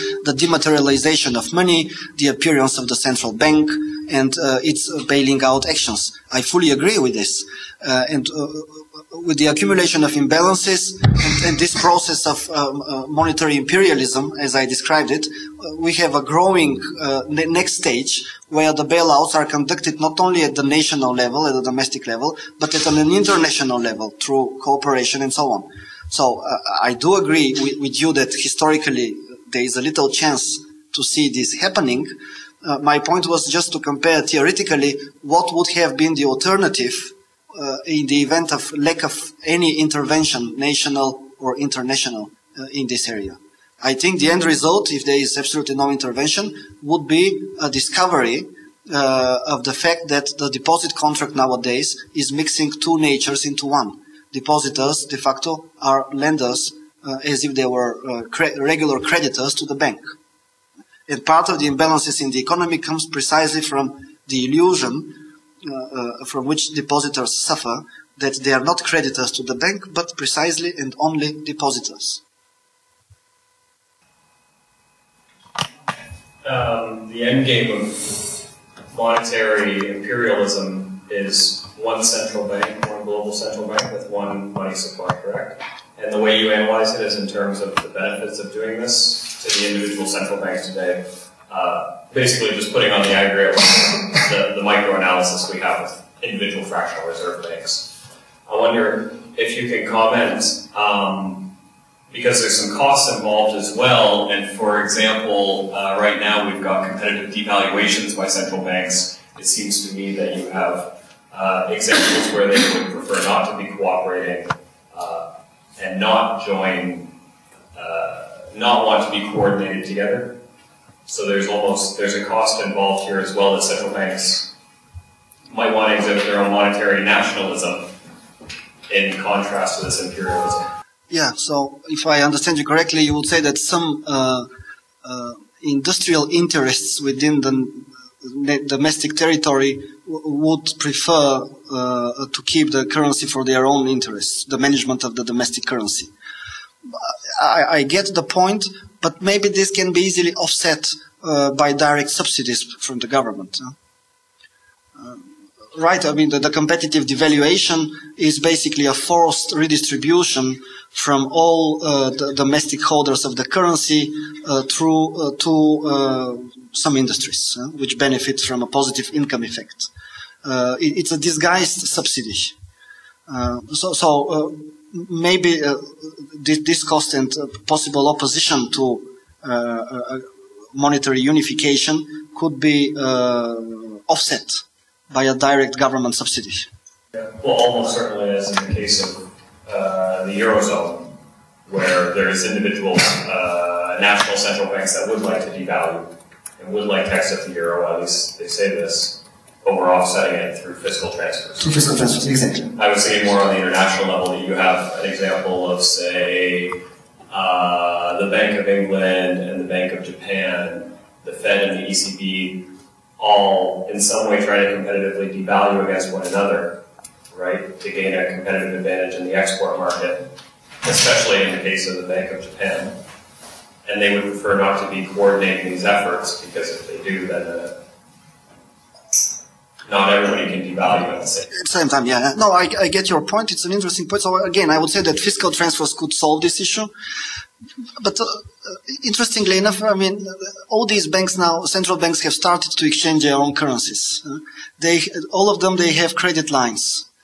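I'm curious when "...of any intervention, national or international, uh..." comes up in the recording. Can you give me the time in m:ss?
0:39.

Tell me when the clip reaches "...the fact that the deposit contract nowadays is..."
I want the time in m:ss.
0:49.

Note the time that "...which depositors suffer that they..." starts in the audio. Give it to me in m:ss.
1:06.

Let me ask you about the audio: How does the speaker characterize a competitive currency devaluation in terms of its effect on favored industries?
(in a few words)
a disguised subsidy.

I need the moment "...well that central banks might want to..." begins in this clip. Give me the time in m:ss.
2:03.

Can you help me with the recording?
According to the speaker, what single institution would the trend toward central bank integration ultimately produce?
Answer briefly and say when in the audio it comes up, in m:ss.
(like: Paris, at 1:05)
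one global central bank, at 1:22.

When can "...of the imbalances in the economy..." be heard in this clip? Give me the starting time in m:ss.
1:01.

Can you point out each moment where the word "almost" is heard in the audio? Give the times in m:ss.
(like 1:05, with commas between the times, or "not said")
2:01, 3:07.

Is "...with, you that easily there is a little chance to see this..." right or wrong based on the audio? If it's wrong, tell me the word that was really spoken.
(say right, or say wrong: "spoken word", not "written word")
wrong: "historically", not "easily".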